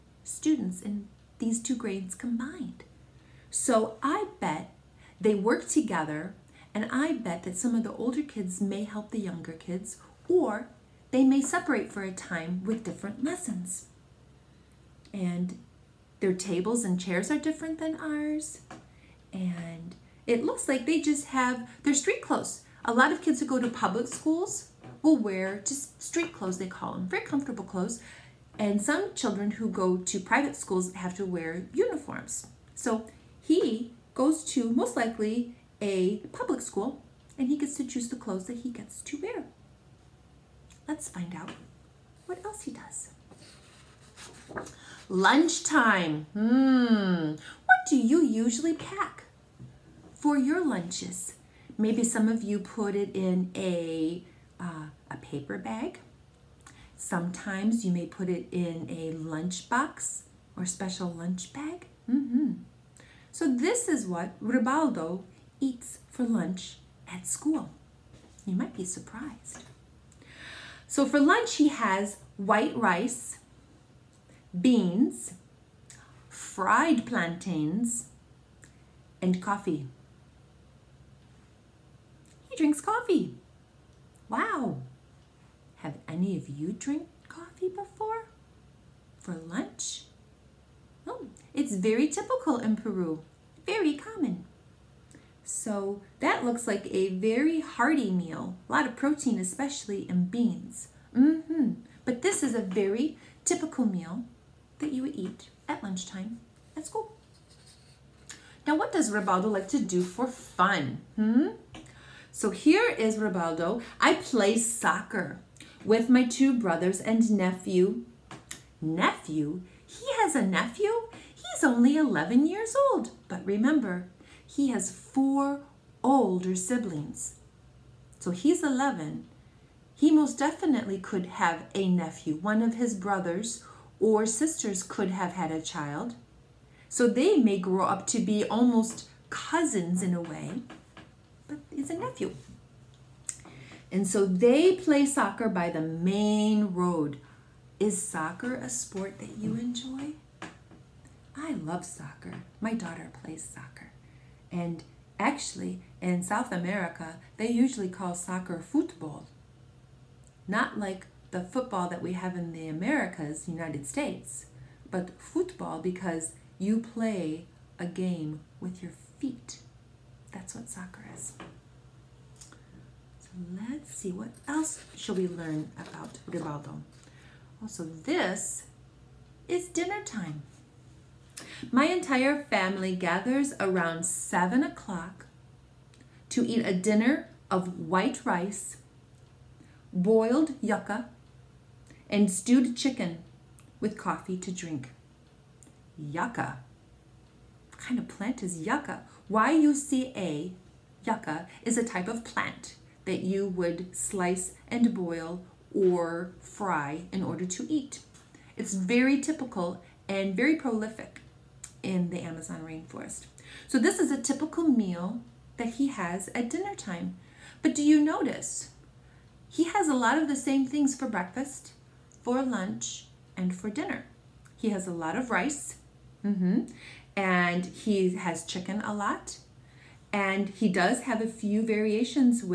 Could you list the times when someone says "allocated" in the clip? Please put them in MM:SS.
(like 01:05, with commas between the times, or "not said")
not said.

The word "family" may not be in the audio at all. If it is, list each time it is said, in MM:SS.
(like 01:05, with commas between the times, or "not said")
03:02.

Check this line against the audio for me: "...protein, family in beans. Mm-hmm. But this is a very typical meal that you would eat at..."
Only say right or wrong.
wrong.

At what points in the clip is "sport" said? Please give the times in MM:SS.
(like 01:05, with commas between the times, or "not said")
02:28.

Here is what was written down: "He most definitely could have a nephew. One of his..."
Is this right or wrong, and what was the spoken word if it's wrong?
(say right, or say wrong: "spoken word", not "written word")
right.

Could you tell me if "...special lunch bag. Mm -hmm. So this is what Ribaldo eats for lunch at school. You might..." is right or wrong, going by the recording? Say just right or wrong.
right.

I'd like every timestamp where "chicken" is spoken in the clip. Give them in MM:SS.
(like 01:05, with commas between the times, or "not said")
03:12, 03:48.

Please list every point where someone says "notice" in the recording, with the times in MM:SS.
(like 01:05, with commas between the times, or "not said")
03:38.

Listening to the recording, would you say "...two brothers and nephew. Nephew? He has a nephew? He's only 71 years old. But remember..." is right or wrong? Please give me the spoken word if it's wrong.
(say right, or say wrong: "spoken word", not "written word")
wrong: "11", not "71".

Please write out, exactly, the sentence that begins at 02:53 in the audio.
So let's see, what else should we learn about Ribaldo?